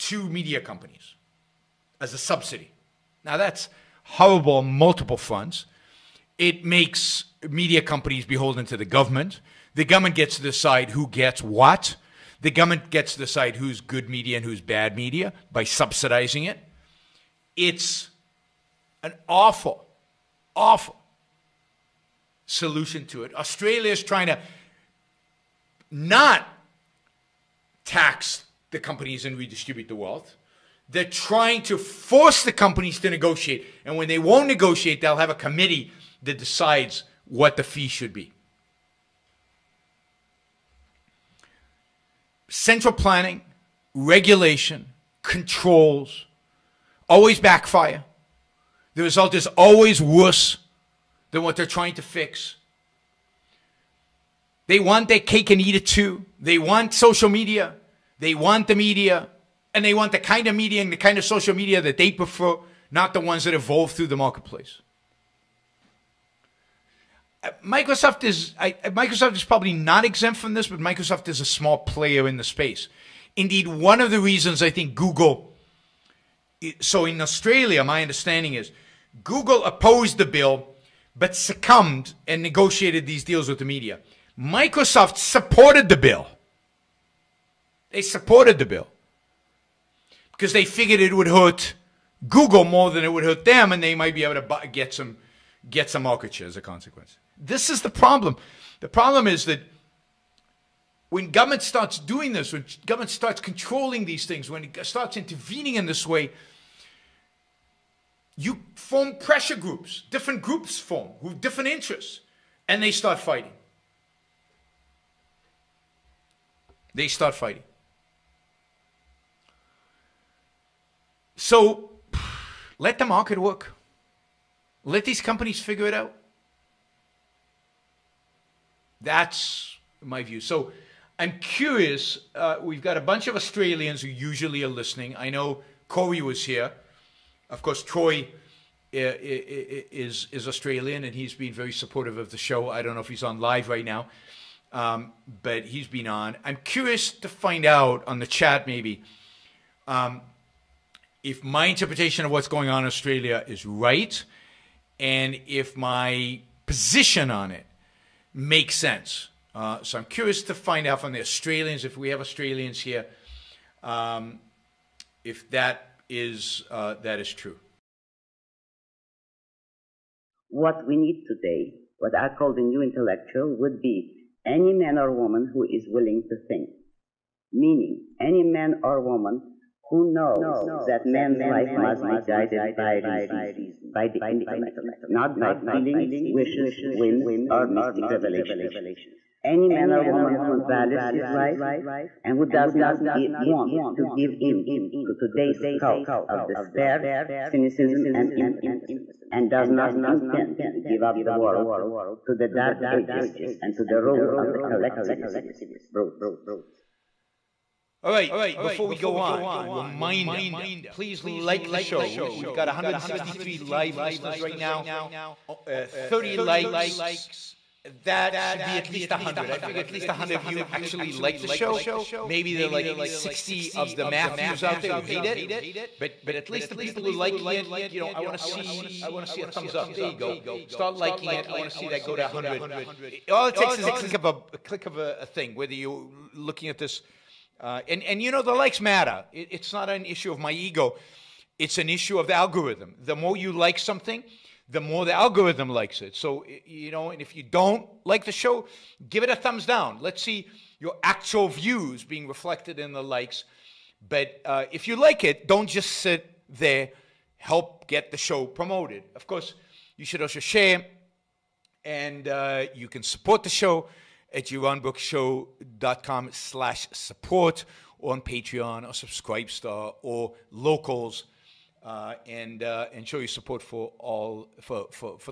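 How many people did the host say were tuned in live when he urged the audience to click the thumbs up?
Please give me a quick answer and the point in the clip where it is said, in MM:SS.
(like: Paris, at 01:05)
163, at 03:32.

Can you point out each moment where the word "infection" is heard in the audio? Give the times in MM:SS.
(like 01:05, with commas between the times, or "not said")
not said.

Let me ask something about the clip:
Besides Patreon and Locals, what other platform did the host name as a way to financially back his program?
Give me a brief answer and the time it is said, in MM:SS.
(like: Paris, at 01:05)
Subscribestar, at 04:28.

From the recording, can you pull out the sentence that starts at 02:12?
Uh, we've got a bunch of Australians who usually are listening.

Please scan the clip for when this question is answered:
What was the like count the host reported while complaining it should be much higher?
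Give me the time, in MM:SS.
03:35.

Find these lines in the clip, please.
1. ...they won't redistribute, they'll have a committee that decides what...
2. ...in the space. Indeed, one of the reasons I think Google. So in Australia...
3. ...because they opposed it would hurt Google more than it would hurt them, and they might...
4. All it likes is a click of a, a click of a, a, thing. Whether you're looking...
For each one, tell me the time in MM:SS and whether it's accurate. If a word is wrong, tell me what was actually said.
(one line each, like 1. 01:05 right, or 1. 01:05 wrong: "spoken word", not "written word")
1. 00:34 wrong: "negotiate", not "redistribute"
2. 01:12 right
3. 01:30 wrong: "figured", not "opposed"
4. 03:53 wrong: "takes", not "likes".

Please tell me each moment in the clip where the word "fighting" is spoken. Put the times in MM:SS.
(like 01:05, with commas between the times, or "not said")
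01:53, 01:57.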